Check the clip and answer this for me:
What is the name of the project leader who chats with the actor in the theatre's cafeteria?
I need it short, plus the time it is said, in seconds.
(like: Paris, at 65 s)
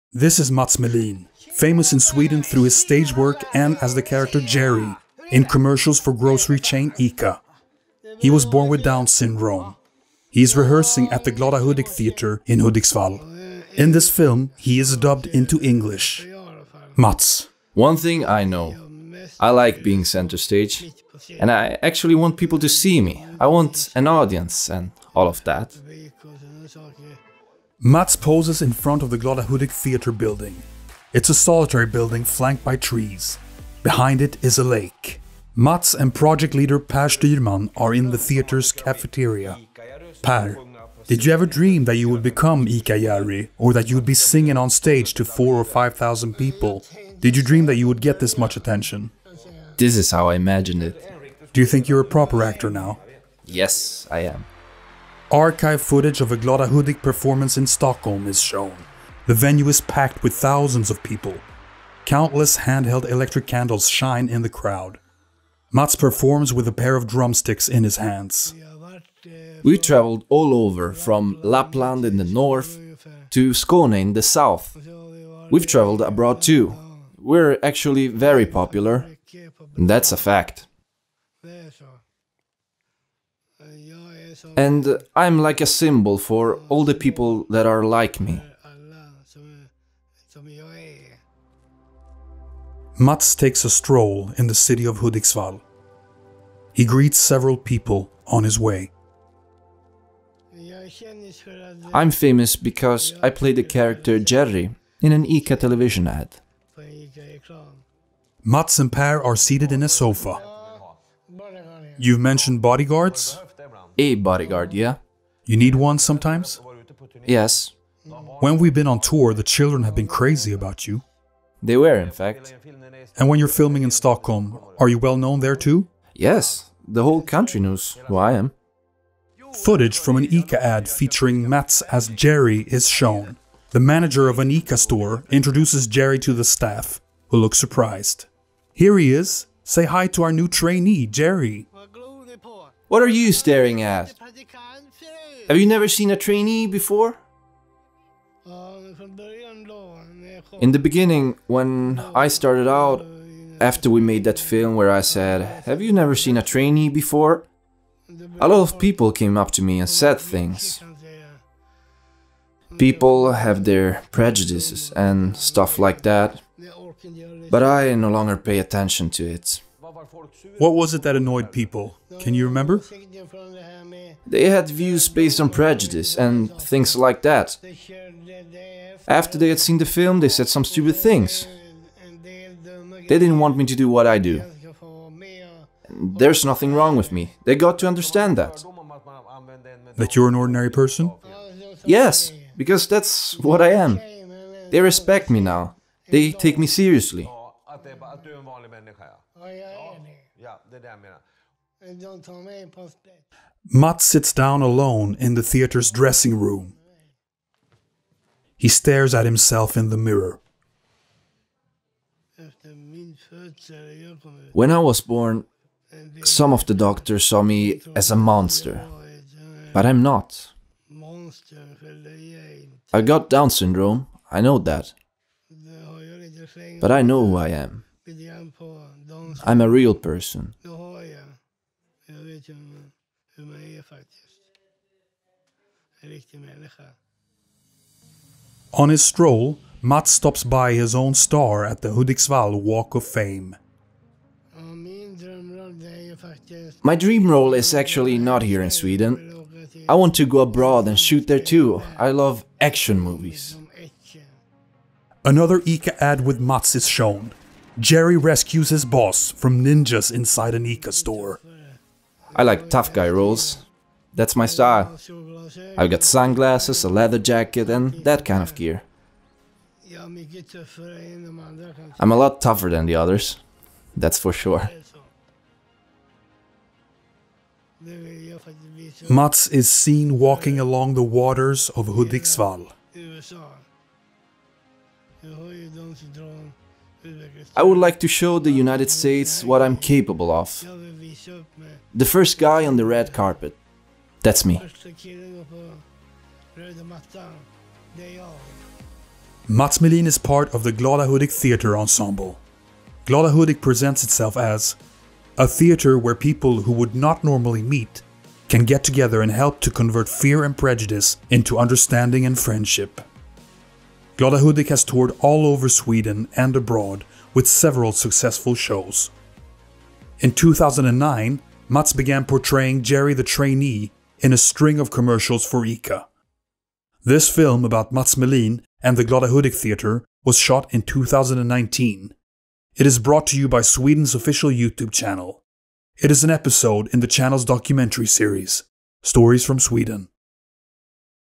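Per Styrman, at 36 s.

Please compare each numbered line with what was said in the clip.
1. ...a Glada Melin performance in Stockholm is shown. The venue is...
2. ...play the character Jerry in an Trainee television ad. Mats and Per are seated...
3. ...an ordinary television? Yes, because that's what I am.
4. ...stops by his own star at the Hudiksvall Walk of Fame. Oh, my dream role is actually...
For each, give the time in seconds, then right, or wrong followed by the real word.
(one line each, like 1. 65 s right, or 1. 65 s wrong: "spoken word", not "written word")
1. 56 s wrong: "Hudik", not "Melin"
2. 103 s wrong: "ICA", not "Trainee"
3. 190 s wrong: "person", not "television"
4. 240 s right.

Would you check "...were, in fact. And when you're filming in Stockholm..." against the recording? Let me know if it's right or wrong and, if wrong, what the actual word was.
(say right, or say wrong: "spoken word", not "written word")
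right.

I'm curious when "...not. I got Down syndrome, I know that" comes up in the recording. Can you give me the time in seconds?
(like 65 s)
220 s.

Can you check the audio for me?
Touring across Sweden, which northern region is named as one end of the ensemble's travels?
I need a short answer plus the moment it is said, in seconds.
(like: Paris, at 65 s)
Lapland, at 71 s.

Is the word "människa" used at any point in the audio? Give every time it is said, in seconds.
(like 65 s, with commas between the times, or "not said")
198 s.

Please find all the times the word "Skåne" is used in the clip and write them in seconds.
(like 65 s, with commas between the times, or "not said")
73 s.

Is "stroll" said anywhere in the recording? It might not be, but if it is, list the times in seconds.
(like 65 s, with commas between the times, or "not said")
93 s, 239 s.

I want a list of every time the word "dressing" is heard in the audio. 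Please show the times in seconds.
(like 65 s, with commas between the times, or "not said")
205 s.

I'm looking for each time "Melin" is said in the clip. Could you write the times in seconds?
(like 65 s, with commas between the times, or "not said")
0 s, 299 s, 328 s.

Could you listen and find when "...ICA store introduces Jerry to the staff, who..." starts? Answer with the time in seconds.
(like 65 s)
134 s.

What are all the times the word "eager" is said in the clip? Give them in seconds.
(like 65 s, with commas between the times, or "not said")
not said.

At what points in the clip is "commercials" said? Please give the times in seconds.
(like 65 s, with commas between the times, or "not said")
5 s, 324 s.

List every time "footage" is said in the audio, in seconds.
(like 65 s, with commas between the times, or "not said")
55 s, 129 s.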